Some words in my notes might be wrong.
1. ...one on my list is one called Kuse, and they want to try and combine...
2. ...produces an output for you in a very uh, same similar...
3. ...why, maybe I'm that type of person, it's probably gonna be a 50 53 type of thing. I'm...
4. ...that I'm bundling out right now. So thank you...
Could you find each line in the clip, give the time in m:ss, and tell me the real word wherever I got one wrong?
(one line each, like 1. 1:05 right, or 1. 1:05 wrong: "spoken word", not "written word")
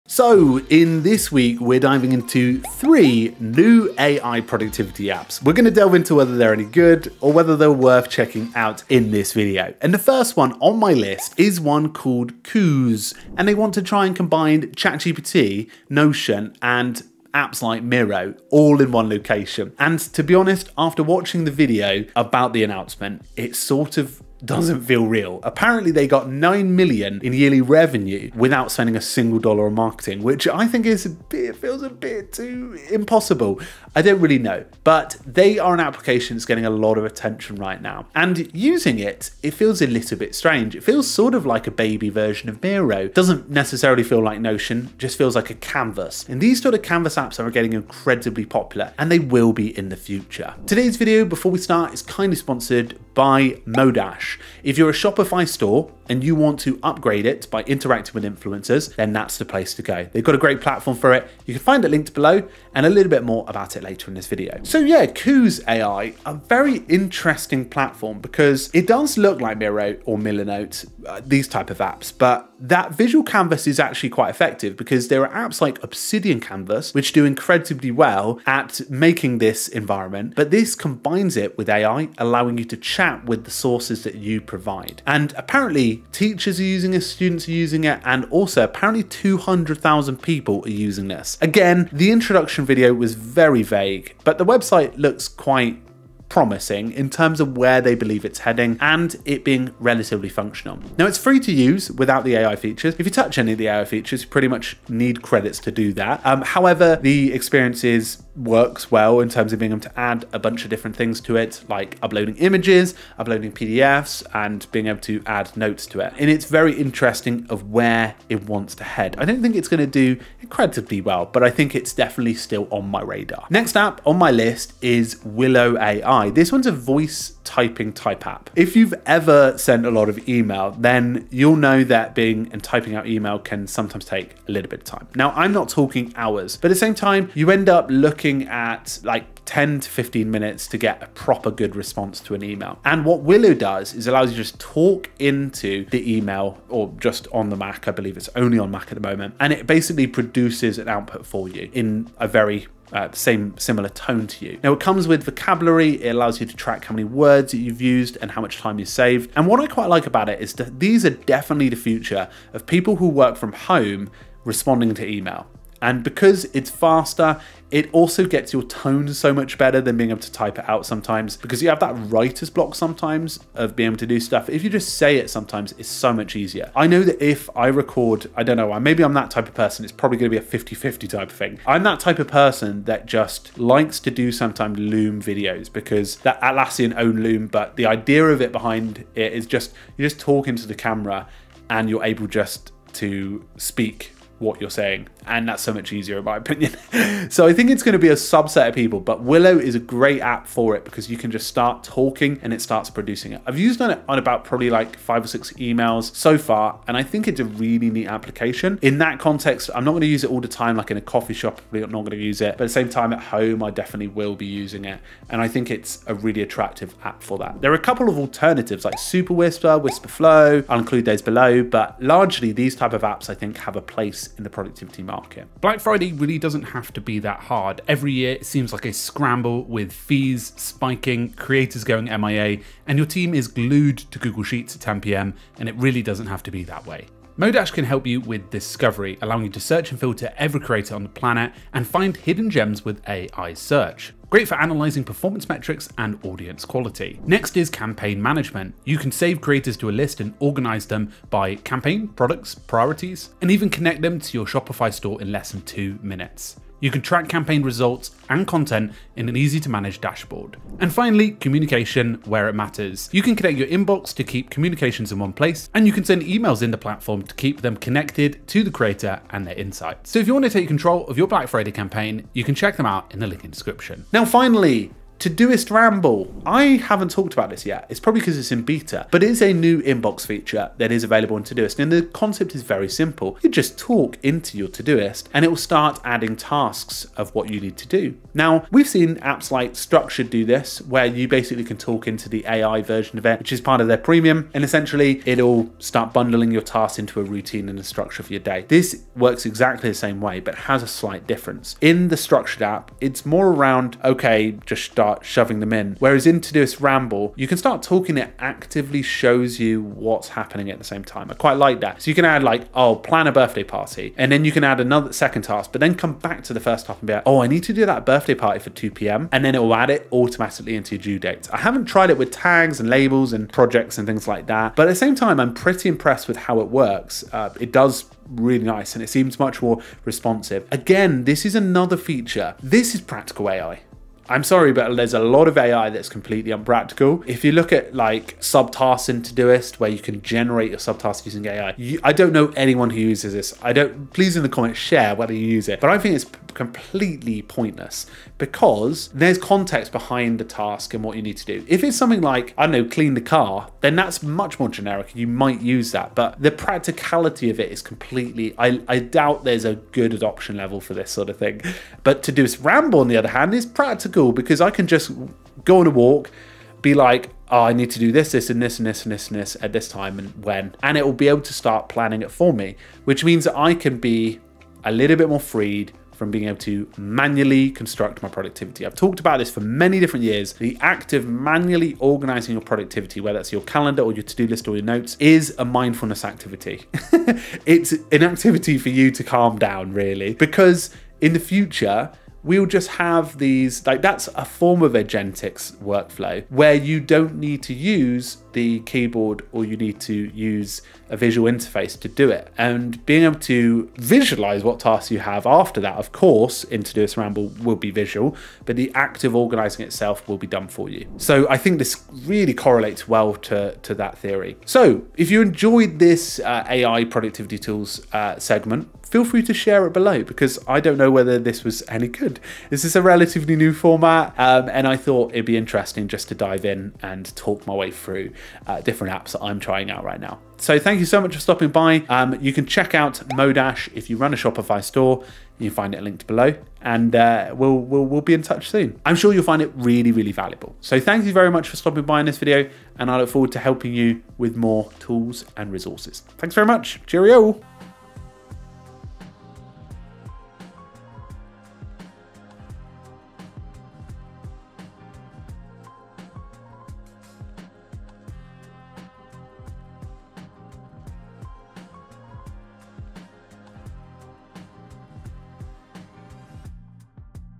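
1. 0:10 right
2. 2:30 right
3. 2:58 wrong: "50", not "53"
4. 7:09 wrong: "trying", not "bundling".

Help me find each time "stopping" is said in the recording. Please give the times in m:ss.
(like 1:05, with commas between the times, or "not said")
7:11, 7:21.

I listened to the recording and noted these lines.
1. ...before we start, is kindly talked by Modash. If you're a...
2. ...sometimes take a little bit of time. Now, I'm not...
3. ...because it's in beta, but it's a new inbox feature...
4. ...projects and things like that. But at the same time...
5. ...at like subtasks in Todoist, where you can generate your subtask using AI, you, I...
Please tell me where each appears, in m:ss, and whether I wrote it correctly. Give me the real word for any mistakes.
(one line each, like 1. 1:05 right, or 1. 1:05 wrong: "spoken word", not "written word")
1. 0:51 wrong: "sponsored", not "talked"
2. 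2:13 right
3. 4:38 right
4. 5:23 right
5. 5:37 right.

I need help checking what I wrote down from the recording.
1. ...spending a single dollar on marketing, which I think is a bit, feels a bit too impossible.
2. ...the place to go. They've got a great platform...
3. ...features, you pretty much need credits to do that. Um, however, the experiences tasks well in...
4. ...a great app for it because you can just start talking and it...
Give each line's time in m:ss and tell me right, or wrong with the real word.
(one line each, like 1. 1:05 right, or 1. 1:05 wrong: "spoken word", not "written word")
1. 0:28 right
2. 0:59 right
3. 1:43 wrong: "works", not "tasks"
4. 3:19 right.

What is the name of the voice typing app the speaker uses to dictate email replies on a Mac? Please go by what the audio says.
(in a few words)
Willow AI.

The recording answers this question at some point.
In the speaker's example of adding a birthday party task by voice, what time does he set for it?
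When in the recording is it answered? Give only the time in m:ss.
5:18.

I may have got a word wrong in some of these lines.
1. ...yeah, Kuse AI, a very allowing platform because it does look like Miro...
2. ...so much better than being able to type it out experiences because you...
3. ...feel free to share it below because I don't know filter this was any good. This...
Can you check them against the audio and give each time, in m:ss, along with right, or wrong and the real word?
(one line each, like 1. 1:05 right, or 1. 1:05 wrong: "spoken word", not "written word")
1. 1:04 wrong: "interesting", not "allowing"
2. 2:49 wrong: "sometimes", not "experiences"
3. 6:59 wrong: "whether", not "filter".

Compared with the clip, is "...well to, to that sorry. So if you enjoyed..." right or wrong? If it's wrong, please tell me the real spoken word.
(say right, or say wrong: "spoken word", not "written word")
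wrong: "theory", not "sorry".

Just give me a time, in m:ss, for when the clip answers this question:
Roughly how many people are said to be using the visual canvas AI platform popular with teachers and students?
1:29.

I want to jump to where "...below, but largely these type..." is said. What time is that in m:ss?
3:41.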